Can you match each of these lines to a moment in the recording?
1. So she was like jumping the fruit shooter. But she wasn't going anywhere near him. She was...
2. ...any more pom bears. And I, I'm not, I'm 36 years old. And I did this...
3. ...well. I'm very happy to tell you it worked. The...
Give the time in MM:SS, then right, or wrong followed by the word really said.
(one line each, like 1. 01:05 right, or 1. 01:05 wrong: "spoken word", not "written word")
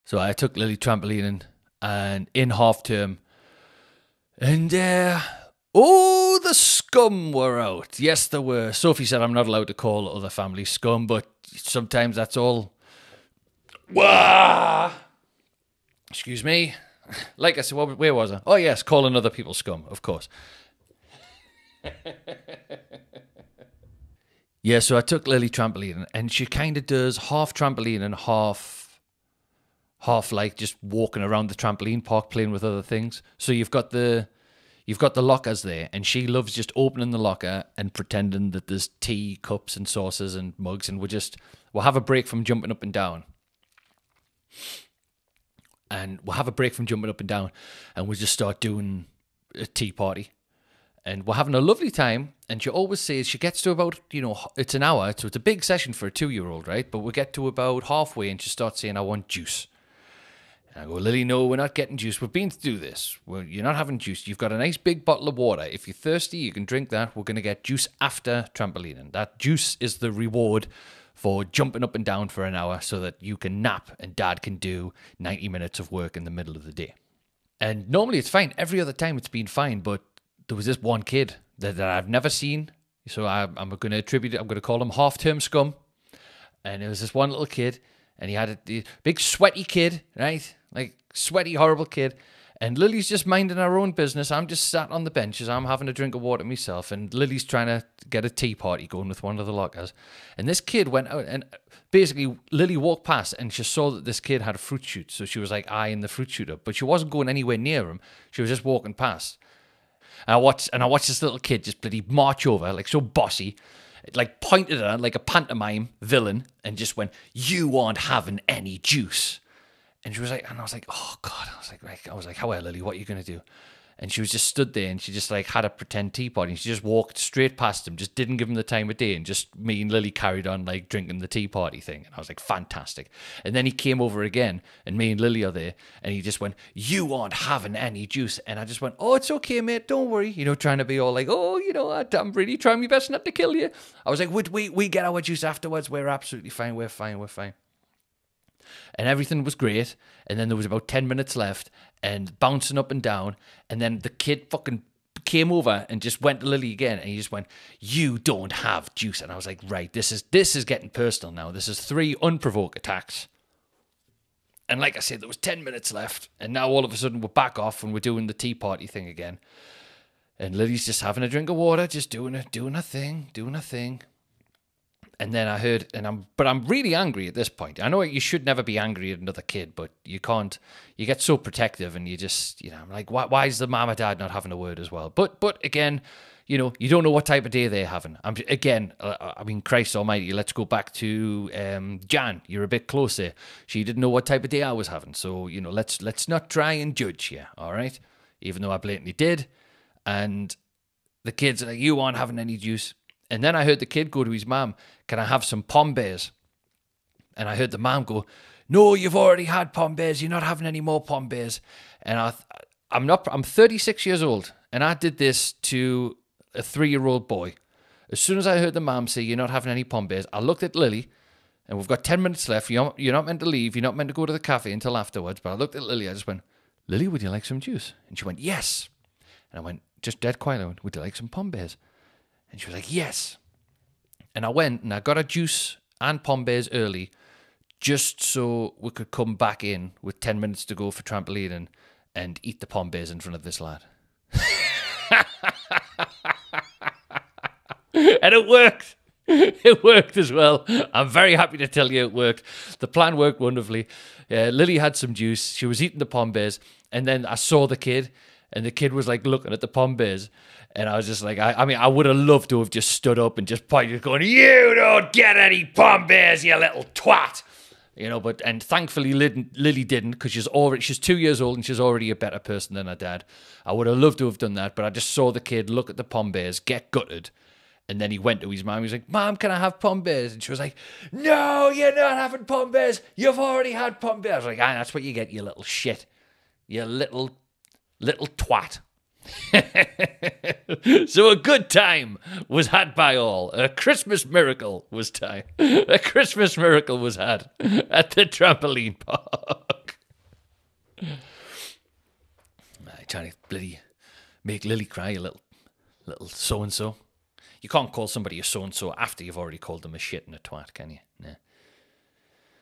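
1. 01:45 wrong: "eyeing", not "jumping"
2. 03:30 right
3. 04:10 right.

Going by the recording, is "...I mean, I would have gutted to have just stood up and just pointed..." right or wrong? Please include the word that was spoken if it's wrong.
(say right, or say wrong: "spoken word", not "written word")
wrong: "loved", not "gutted".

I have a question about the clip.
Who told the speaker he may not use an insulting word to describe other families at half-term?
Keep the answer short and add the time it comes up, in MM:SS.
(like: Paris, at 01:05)
Sophie, at 00:08.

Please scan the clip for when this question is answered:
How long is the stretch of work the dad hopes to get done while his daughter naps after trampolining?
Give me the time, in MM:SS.
01:15.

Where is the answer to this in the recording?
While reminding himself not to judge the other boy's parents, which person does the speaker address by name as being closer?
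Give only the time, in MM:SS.
03:12.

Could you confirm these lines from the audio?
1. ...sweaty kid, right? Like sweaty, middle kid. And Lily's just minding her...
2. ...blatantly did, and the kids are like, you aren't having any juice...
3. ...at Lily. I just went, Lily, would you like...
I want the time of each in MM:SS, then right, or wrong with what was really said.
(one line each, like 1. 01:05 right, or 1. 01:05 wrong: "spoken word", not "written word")
1. 01:29 wrong: "horrible", not "middle"
2. 03:18 right
3. 03:45 right.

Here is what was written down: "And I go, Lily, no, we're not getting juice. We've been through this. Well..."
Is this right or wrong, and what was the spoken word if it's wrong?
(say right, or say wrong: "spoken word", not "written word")
right.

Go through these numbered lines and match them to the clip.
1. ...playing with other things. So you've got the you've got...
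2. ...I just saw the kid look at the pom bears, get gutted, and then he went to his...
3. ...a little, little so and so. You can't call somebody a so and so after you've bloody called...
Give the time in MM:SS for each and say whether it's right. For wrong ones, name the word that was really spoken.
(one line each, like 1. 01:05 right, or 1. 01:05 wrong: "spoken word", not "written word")
1. 00:32 right
2. 04:34 right
3. 05:05 wrong: "already", not "bloody".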